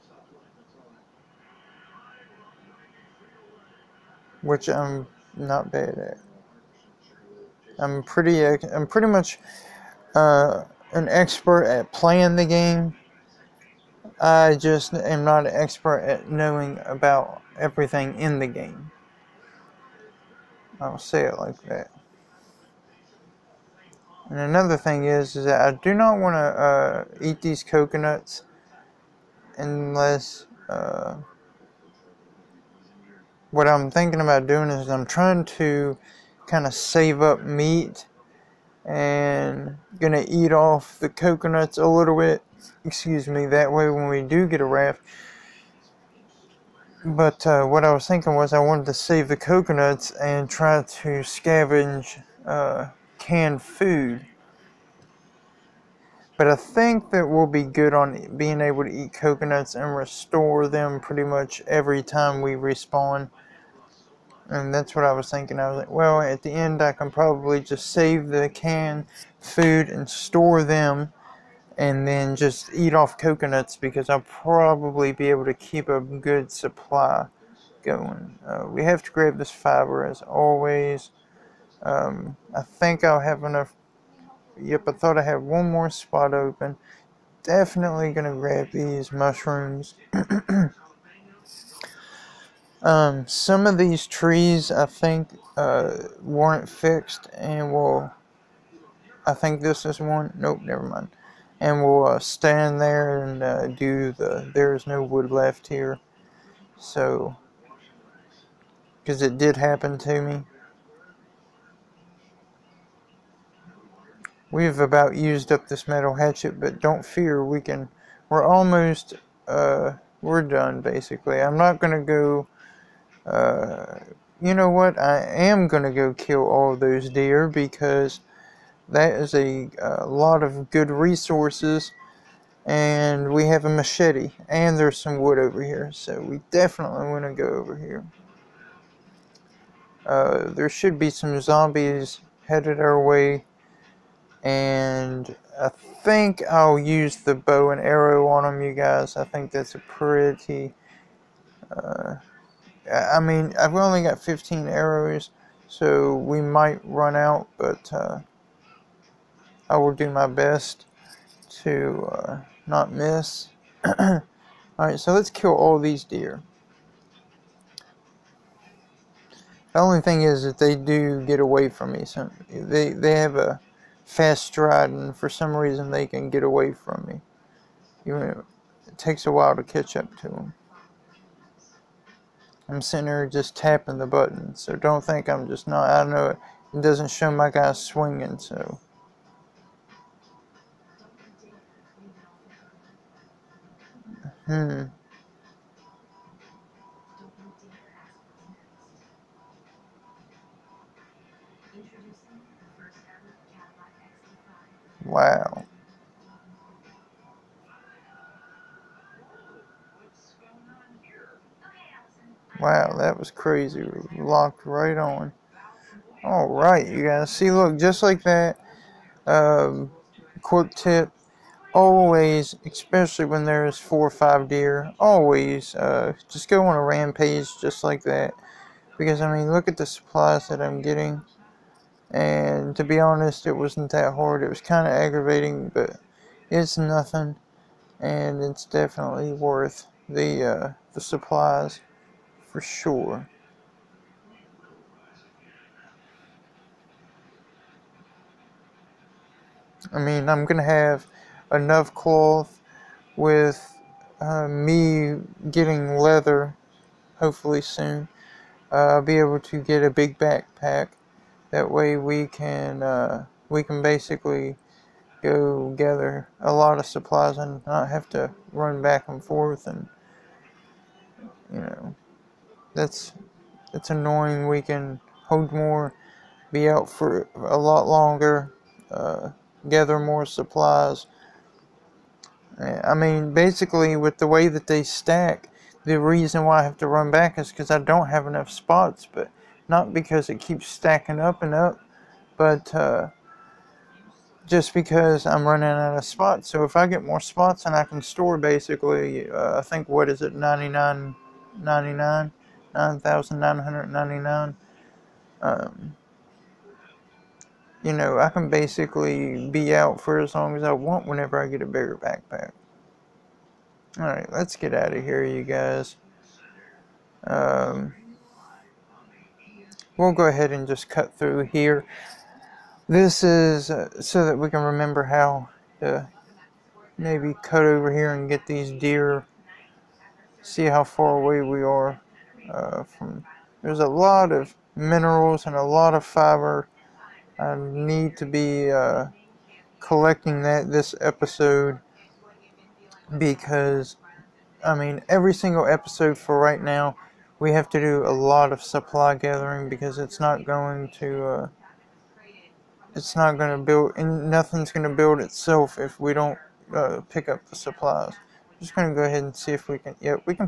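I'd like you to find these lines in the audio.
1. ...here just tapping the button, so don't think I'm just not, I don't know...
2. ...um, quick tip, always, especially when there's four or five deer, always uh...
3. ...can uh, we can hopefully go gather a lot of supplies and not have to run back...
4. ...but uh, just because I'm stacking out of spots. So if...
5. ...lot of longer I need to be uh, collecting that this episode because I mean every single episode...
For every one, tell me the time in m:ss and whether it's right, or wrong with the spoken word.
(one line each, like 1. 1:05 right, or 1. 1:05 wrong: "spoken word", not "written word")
1. 3:03 right
2. 3:39 right
3. 4:22 wrong: "basically", not "hopefully"
4. 4:52 wrong: "running", not "stacking"
5. 5:35 wrong: "fiber", not "longer".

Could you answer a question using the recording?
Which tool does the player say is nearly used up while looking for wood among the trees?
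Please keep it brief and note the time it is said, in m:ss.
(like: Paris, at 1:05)
metal hatchet, at 1:55.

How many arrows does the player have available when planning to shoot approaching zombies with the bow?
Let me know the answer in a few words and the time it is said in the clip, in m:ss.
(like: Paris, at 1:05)
15, at 2:34.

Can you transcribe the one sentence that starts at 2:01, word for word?
I'm not going to go uh, you know what?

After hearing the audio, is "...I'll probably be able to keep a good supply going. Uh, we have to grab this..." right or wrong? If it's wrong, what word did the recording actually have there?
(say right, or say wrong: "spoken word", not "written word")
right.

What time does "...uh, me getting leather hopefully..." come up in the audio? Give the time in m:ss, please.
4:14.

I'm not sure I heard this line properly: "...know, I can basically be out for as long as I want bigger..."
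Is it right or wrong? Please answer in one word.
wrong.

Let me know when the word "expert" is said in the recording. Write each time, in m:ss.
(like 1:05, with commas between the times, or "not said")
0:11, 0:15.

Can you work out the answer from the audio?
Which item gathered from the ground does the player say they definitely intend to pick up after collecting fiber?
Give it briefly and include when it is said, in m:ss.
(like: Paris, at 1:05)
mushrooms, at 1:29.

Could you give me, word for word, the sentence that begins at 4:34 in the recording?
We can hold more, be out for a lot longer, uh, gather more supplies.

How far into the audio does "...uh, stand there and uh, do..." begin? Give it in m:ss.
1:42.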